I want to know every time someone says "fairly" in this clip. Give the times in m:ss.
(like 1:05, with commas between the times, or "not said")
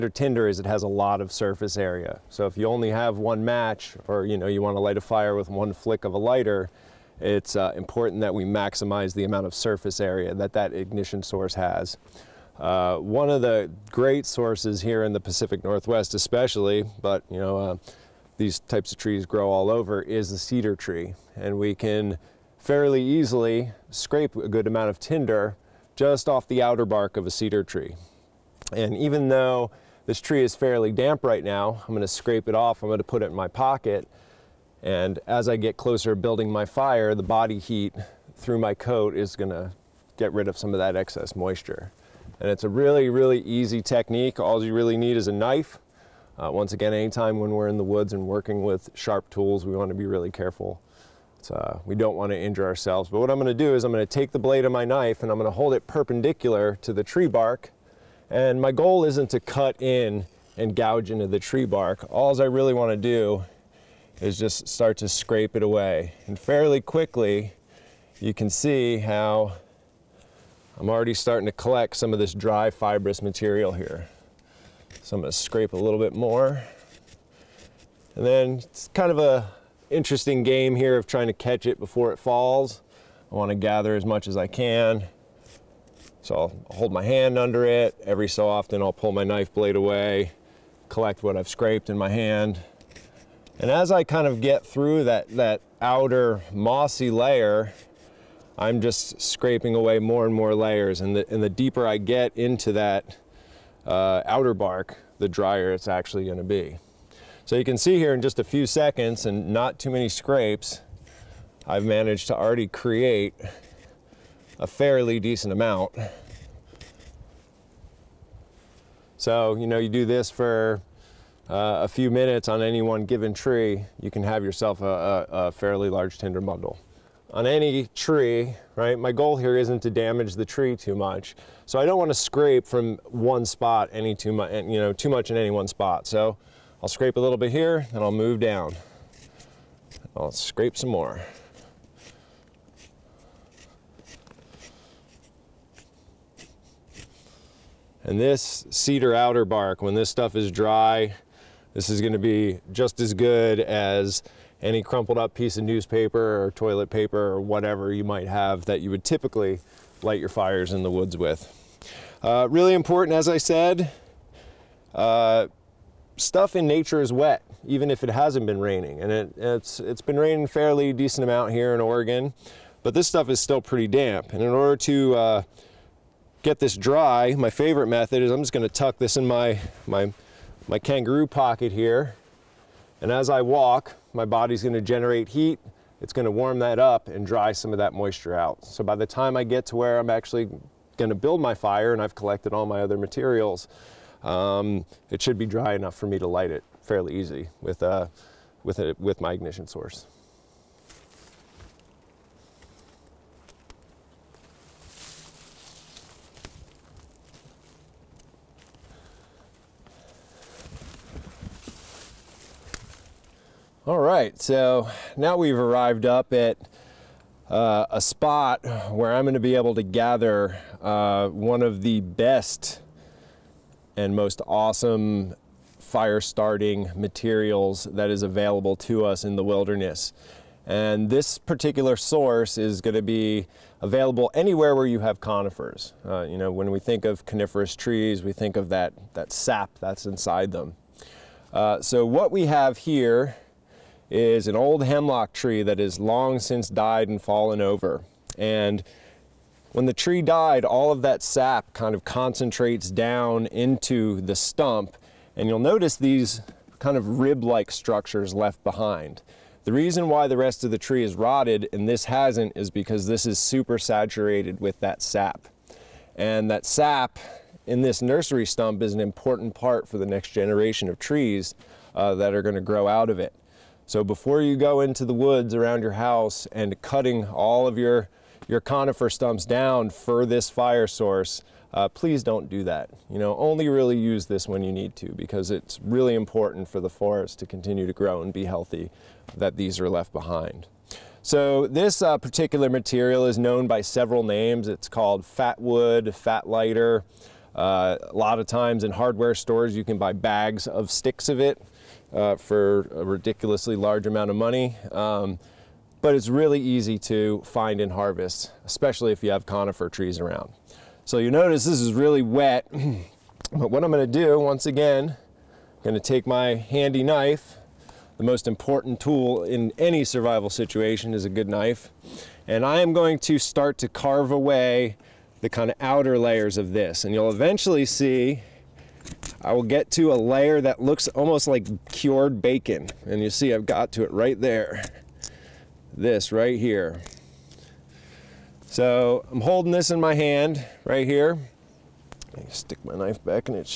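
0:22, 0:30, 1:06, 1:54, 2:05, 2:50, 3:16.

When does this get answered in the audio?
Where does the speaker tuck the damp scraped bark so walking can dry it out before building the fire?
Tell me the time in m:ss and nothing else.
3:00.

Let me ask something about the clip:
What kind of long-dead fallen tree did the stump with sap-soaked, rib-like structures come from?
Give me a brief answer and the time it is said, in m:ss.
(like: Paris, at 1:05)
hemlock, at 4:04.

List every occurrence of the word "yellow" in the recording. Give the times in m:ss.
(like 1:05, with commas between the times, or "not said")
not said.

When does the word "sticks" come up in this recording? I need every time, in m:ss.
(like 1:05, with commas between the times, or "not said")
5:00, 5:42.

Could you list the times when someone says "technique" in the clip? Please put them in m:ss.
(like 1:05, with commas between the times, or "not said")
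0:43.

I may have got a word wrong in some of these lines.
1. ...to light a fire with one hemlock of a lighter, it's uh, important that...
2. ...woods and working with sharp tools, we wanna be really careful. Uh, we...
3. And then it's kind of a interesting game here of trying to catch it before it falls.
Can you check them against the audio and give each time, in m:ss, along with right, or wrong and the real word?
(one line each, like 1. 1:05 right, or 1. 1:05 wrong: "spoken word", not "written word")
1. 0:04 wrong: "flick", not "hemlock"
2. 0:47 right
3. 1:18 right.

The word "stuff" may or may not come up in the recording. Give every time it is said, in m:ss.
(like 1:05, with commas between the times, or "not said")
2:30, 2:46, 2:53.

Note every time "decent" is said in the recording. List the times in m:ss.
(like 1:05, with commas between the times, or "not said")
1:55, 2:50.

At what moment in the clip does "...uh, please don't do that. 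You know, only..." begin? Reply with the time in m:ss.
4:41.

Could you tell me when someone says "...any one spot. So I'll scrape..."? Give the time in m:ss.
2:15.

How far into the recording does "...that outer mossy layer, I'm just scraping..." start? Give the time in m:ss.
1:35.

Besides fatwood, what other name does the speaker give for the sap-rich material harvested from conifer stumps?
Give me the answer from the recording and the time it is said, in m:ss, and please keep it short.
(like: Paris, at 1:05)
fat lighter, at 4:56.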